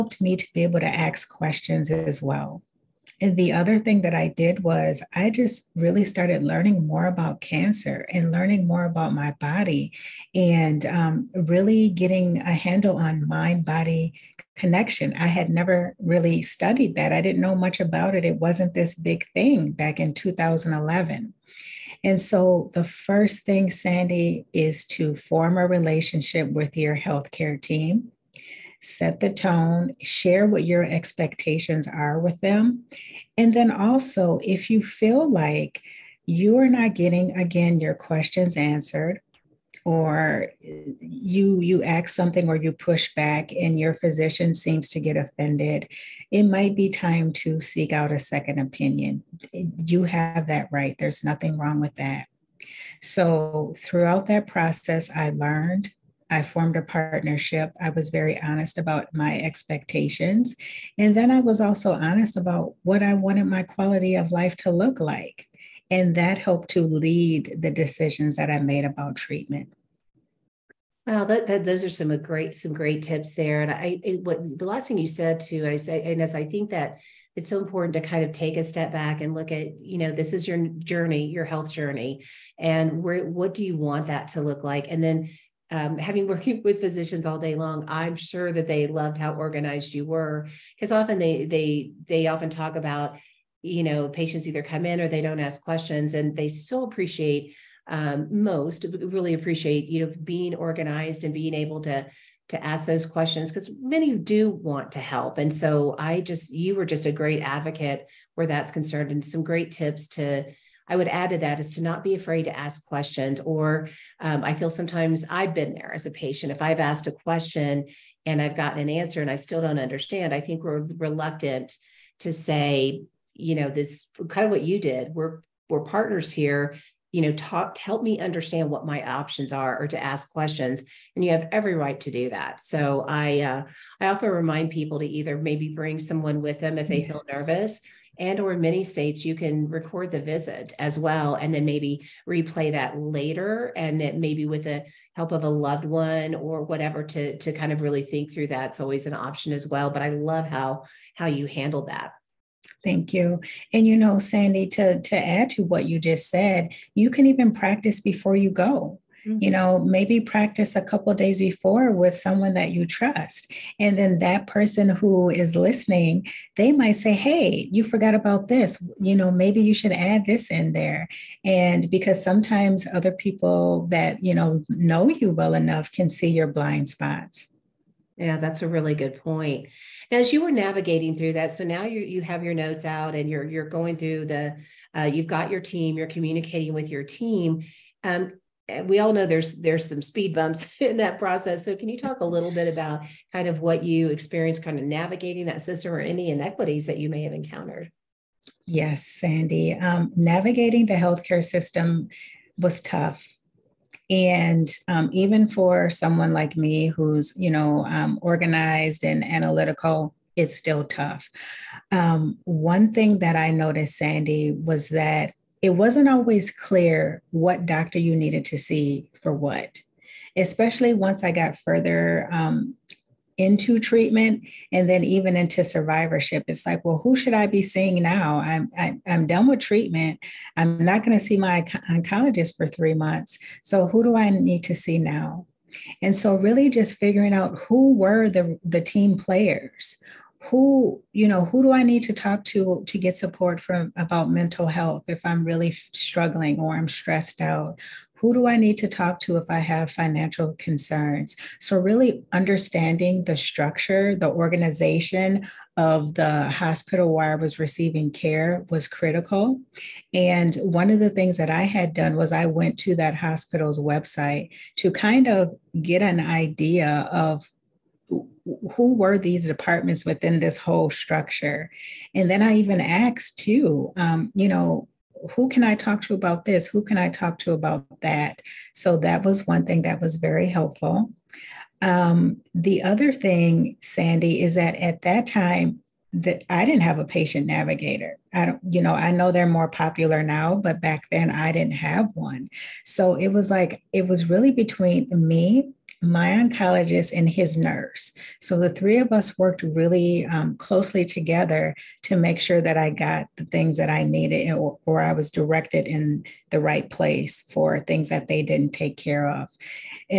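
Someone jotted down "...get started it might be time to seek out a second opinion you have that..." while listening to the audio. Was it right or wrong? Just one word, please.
wrong.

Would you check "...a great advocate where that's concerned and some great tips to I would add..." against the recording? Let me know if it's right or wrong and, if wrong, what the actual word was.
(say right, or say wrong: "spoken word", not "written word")
right.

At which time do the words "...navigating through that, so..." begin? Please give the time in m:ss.
3:00.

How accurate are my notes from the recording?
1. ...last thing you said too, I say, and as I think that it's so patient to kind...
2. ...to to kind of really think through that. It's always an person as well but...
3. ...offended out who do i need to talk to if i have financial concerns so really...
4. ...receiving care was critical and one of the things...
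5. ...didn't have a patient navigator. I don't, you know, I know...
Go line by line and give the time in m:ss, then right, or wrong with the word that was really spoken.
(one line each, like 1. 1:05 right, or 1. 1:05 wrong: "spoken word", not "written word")
1. 1:14 wrong: "important", not "patient"
2. 2:27 wrong: "option", not "person"
3. 4:06 wrong: "stressed", not "offended"
4. 4:17 right
5. 4:46 right.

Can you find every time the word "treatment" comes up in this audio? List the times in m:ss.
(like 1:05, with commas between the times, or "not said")
1:09, 3:43, 3:49.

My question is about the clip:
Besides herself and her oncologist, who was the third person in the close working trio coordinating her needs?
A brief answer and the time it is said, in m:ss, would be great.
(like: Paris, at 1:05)
His nurse, at 4:57.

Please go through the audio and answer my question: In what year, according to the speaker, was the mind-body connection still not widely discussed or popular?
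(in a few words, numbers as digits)
2011.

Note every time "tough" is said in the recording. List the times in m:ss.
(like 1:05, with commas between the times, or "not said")
3:22, 3:30.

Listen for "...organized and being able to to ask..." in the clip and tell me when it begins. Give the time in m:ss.
1:40.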